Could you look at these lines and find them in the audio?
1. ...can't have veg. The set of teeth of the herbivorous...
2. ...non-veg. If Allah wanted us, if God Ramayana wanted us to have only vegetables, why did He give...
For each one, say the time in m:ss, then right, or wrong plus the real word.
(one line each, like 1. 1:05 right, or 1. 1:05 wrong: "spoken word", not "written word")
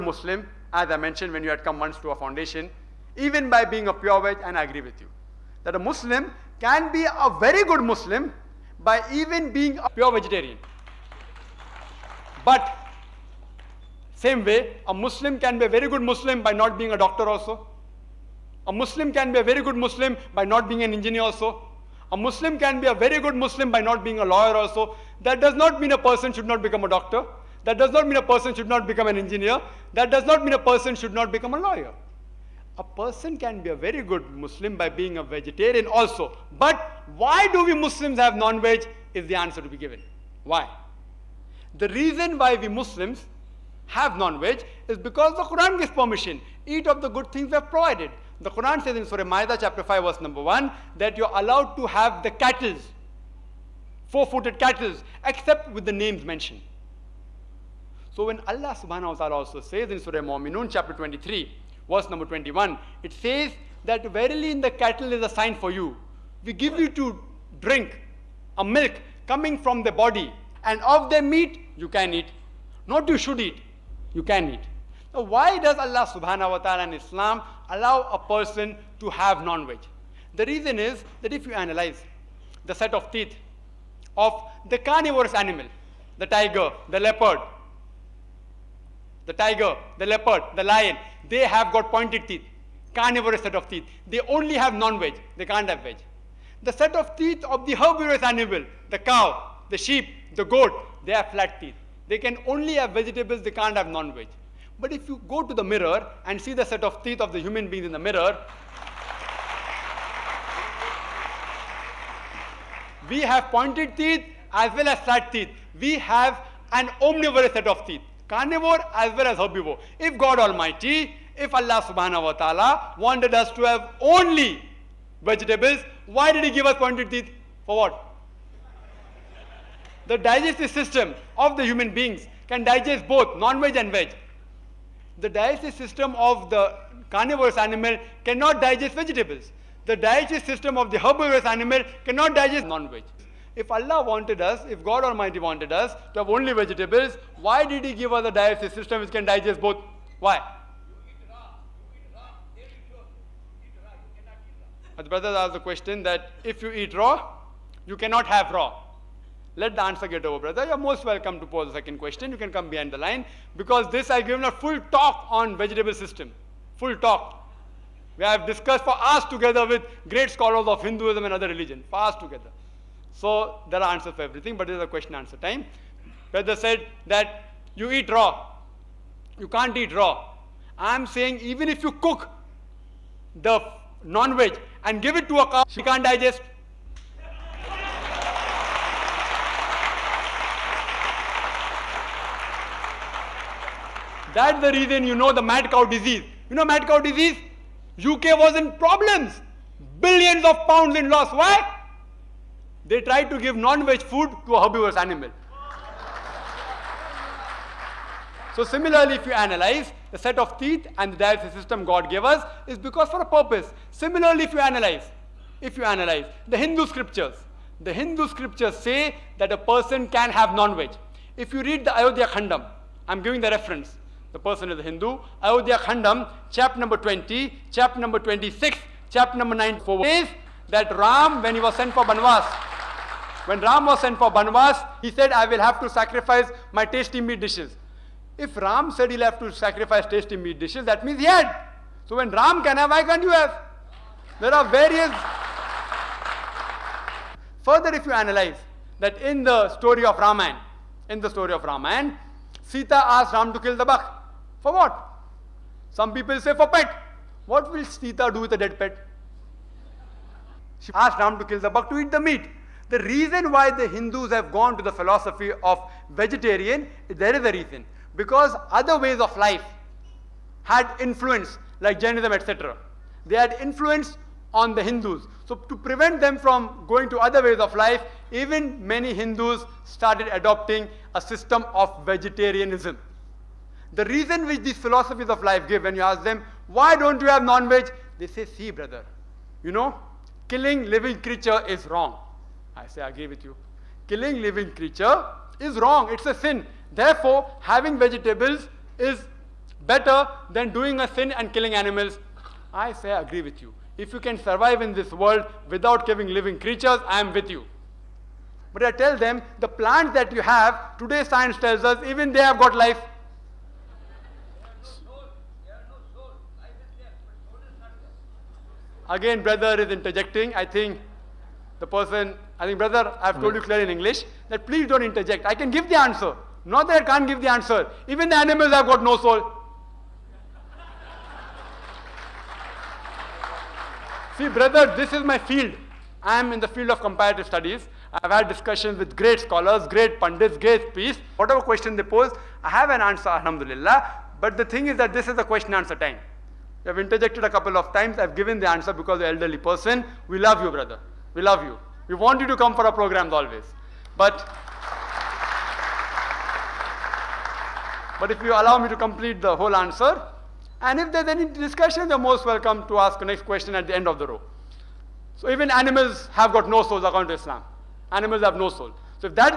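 1. 1:35 right
2. 2:22 wrong: "Almighty", not "Ramayana".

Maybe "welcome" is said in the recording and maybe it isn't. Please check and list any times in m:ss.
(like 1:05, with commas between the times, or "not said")
2:41, 6:02.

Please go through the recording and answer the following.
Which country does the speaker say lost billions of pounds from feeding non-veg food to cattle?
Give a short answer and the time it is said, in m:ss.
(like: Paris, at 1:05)
UK, at 3:17.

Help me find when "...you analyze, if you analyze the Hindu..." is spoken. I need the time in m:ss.
3:34.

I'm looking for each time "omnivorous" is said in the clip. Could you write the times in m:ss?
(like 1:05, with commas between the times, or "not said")
1:57.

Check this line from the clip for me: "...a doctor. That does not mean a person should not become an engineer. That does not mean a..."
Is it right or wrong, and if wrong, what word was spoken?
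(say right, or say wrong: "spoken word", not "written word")
right.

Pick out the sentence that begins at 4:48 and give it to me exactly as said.
They say, see, brother, you know, killing living creature is wrong.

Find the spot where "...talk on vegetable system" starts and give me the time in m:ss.
2:44.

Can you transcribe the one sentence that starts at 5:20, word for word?
I think the person, I think, brother, I've told you clearly in English that please don't interject.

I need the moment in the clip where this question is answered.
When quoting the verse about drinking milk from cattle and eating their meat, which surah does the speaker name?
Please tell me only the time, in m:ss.
1:00.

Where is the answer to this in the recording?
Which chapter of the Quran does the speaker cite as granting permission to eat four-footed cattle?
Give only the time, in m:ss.
0:49.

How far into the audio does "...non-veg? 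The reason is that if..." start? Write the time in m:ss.
1:19.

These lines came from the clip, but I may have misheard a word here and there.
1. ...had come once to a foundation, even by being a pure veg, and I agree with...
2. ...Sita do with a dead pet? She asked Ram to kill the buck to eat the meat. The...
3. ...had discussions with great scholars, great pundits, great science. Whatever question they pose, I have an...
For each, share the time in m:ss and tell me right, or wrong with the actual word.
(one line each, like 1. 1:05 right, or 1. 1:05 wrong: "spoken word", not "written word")
1. 0:01 right
2. 4:17 right
3. 5:38 wrong: "peace", not "science".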